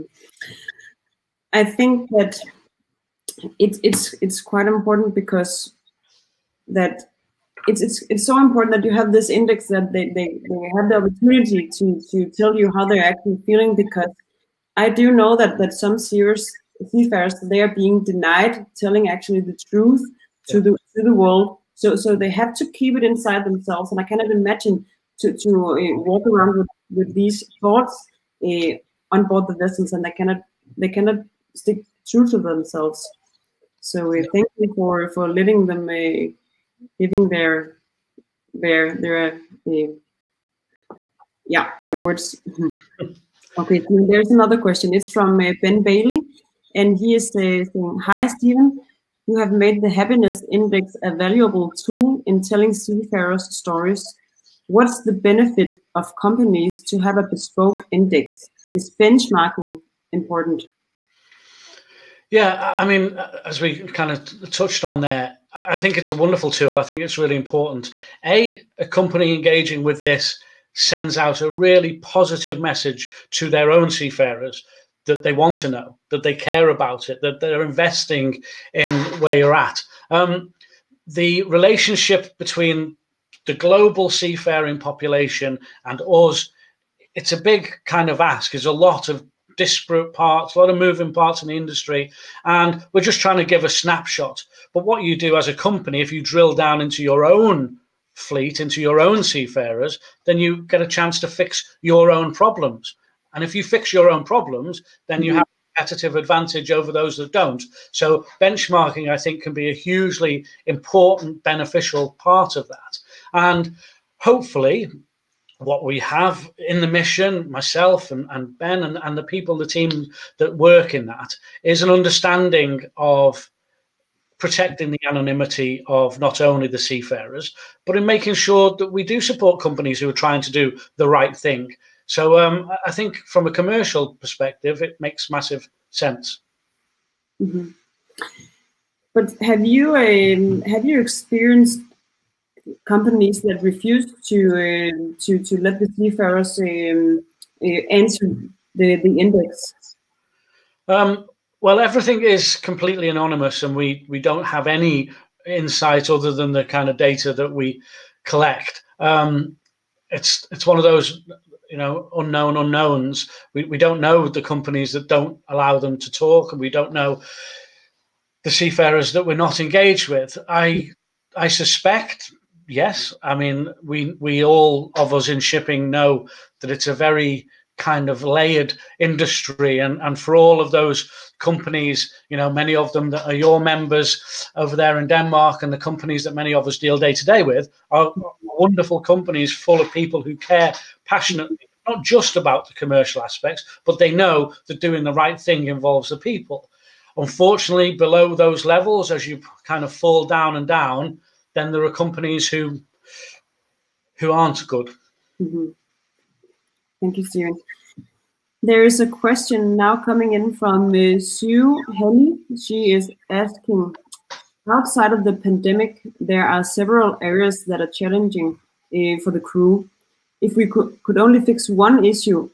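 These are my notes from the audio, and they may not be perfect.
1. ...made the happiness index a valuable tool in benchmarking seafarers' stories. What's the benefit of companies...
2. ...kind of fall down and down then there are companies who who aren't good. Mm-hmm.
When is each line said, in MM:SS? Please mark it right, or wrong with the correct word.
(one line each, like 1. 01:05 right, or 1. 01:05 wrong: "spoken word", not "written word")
1. 00:49 wrong: "telling", not "benchmarking"
2. 03:19 right.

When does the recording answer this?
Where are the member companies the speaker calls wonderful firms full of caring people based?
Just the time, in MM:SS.
03:05.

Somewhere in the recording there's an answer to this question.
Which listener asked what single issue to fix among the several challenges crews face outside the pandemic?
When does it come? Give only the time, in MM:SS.
03:31.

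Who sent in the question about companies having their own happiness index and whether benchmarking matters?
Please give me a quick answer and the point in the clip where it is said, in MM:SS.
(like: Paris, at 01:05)
Ben Bailey, at 00:45.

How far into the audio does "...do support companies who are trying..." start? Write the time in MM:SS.
02:09.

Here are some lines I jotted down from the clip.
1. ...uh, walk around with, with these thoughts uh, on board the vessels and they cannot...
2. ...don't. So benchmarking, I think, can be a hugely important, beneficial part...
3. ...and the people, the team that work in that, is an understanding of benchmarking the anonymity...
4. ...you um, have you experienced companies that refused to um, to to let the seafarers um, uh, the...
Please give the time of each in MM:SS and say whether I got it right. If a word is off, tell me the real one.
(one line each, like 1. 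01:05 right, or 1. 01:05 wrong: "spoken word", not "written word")
1. 00:25 right
2. 01:47 right
3. 01:59 wrong: "protecting", not "benchmarking"
4. 02:19 right.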